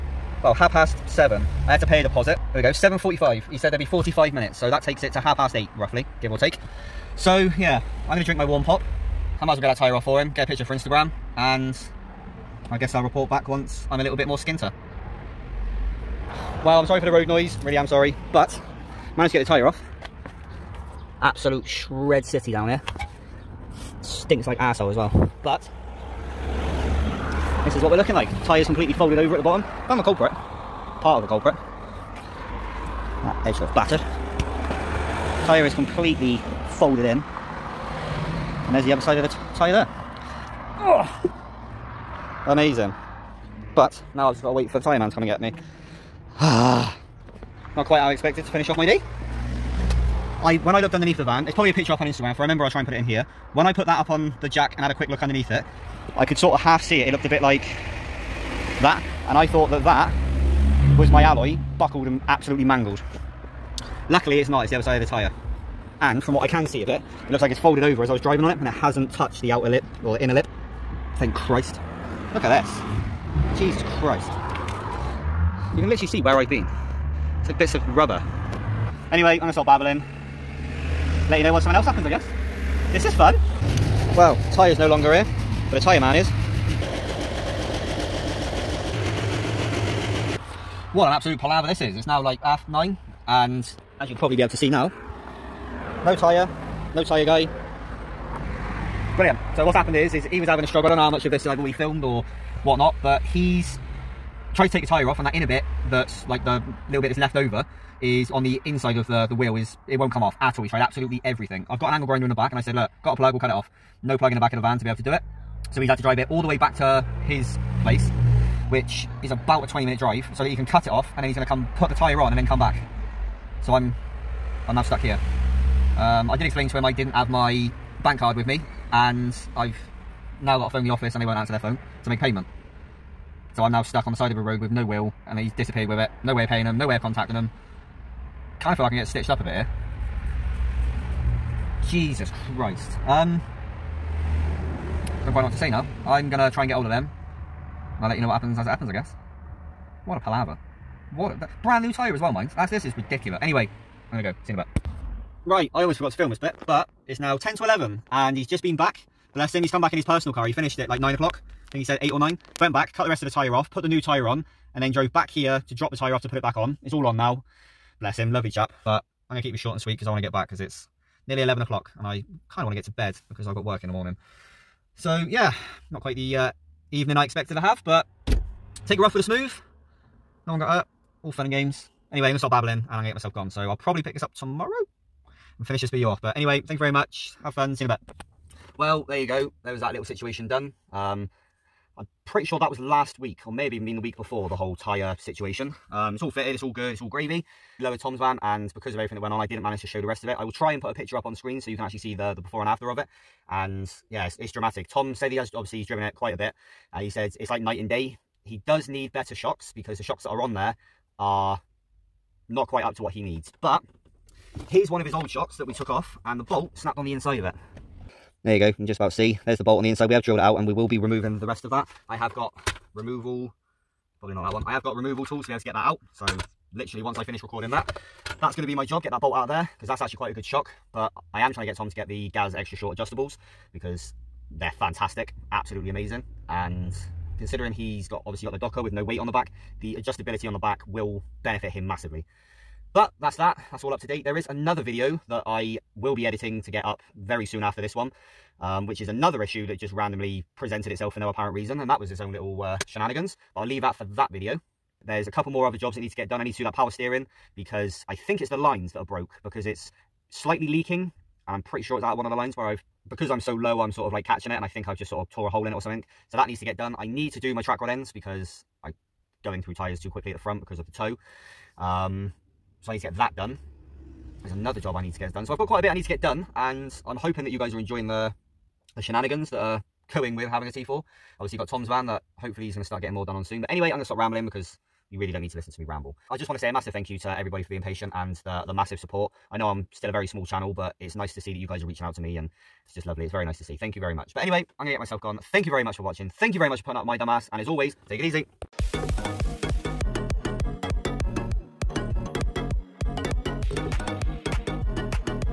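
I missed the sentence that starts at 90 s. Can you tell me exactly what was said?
What an absolute palaver this is.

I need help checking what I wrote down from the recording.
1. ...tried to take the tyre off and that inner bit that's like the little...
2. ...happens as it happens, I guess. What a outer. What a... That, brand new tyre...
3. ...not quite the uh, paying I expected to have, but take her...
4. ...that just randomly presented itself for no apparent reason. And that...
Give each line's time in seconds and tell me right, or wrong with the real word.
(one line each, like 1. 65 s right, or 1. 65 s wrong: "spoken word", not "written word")
1. 104 s right
2. 148 s wrong: "palaver", not "outer"
3. 175 s wrong: "evening", not "paying"
4. 249 s right.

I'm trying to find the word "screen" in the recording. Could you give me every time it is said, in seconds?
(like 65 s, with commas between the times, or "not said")
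201 s.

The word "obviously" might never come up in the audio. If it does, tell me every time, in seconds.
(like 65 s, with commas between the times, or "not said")
205 s, 238 s, 281 s.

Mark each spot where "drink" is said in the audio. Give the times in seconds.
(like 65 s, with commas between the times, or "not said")
8 s.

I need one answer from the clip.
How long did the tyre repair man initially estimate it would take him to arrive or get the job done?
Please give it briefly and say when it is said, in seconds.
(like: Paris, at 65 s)
45 minutes, at 3 s.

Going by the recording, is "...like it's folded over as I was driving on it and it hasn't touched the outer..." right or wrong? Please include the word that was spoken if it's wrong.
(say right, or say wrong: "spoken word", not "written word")
right.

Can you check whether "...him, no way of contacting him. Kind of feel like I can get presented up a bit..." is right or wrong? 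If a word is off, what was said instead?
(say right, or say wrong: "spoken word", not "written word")
wrong: "stitched", not "presented".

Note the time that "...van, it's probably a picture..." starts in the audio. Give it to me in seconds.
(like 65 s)
51 s.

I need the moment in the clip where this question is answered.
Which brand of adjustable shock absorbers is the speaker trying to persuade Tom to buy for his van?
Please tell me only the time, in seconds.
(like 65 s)
232 s.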